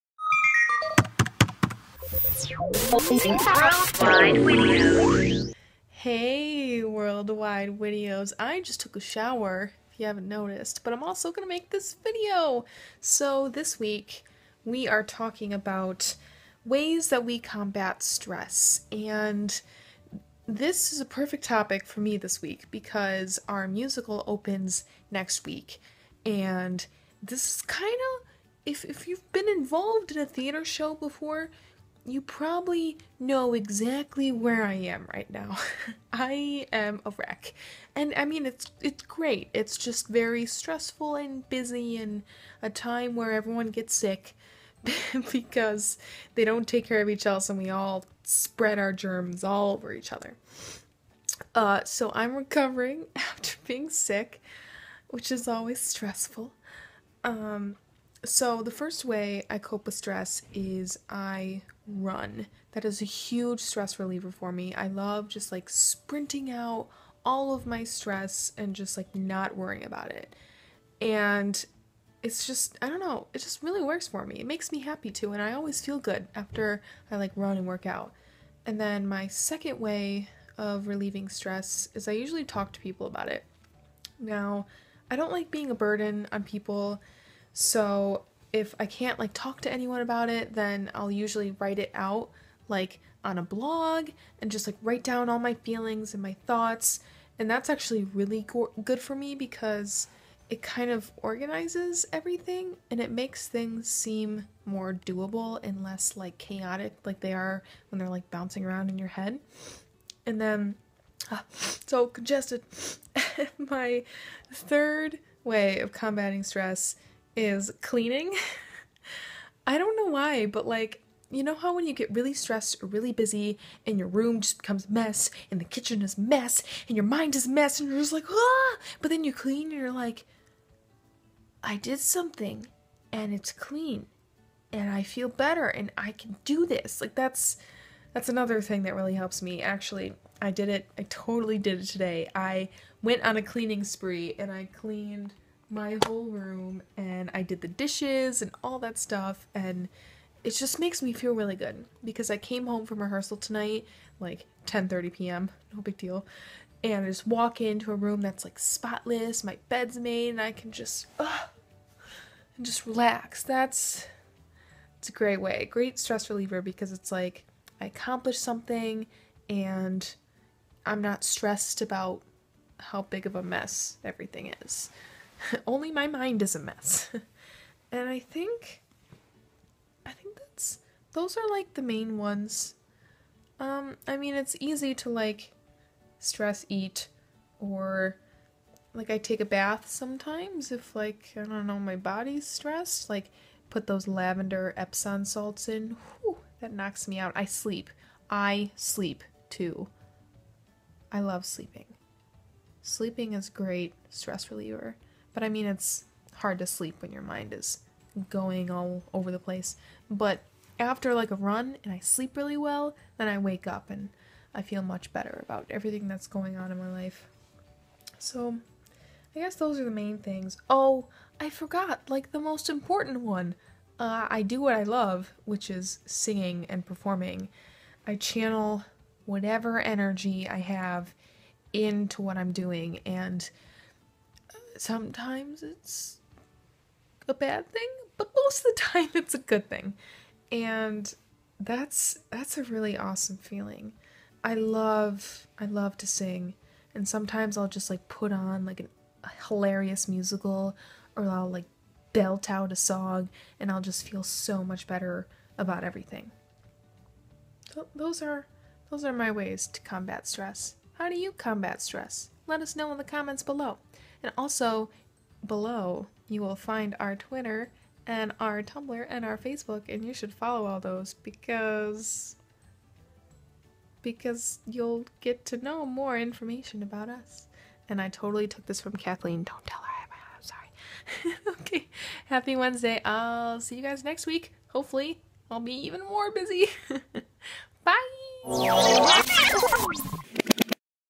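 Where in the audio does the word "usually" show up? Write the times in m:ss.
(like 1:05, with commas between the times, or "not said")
1:22, 1:31.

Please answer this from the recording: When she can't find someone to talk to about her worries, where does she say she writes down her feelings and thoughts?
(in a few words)
a blog.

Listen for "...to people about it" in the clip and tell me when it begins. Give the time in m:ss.
1:22.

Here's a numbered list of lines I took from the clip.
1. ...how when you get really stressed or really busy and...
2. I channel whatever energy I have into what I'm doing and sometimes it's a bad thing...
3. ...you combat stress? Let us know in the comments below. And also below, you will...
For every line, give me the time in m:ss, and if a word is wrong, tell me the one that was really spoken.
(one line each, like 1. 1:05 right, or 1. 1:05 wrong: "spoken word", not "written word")
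1. 2:01 right
2. 3:48 right
3. 4:21 right.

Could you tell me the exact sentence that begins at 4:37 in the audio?
And I totally took this from Kathleen.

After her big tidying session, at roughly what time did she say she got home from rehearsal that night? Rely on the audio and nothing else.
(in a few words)
10:30 p.m.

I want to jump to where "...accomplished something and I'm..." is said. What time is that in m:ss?
2:47.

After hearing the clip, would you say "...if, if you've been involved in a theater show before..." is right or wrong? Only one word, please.
right.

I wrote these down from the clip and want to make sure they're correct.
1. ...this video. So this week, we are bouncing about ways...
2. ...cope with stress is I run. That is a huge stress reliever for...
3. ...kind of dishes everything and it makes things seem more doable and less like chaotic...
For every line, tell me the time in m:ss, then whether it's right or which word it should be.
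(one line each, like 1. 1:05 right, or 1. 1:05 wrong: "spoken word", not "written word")
1. 0:11 wrong: "talking", not "bouncing"
2. 0:59 right
3. 1:40 wrong: "organizes", not "dishes".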